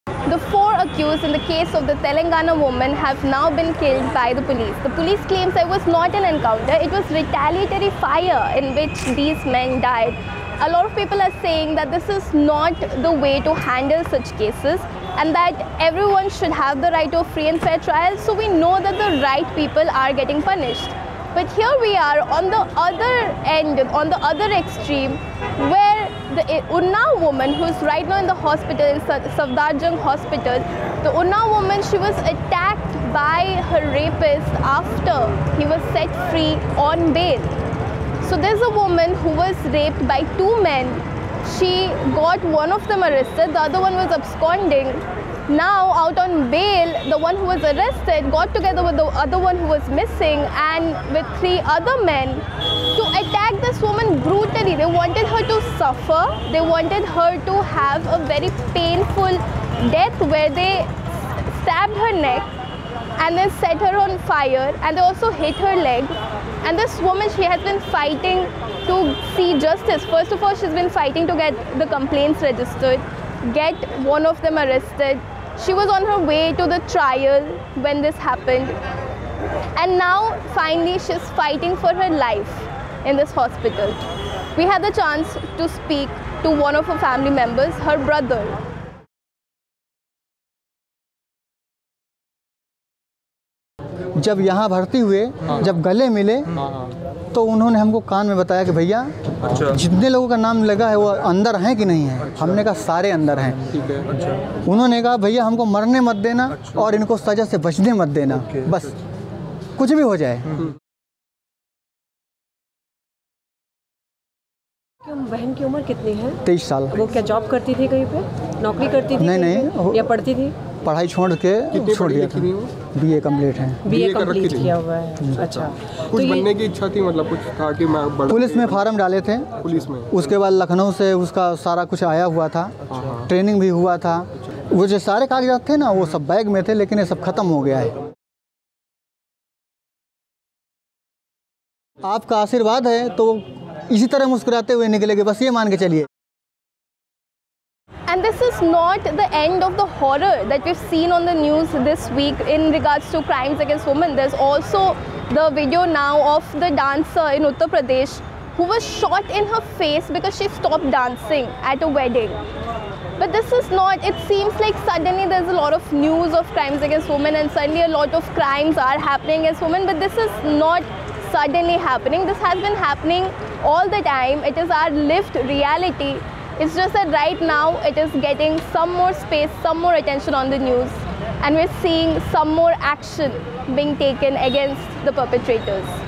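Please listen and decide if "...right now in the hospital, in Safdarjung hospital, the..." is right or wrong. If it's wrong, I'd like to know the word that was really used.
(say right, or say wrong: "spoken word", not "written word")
right.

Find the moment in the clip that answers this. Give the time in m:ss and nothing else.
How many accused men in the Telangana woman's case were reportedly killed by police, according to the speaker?
0:00.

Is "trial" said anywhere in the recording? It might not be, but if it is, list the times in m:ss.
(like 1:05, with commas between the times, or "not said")
0:17, 1:16.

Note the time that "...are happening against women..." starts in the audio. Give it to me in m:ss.
2:48.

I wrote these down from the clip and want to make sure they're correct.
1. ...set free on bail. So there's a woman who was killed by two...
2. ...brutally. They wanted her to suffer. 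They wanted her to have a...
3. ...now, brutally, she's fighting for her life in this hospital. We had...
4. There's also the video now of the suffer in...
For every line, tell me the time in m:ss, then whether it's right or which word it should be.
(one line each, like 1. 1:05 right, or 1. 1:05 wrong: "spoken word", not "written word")
1. 0:35 wrong: "raped", not "killed"
2. 0:54 right
3. 1:19 wrong: "finally", not "brutally"
4. 2:34 wrong: "dancer", not "suffer".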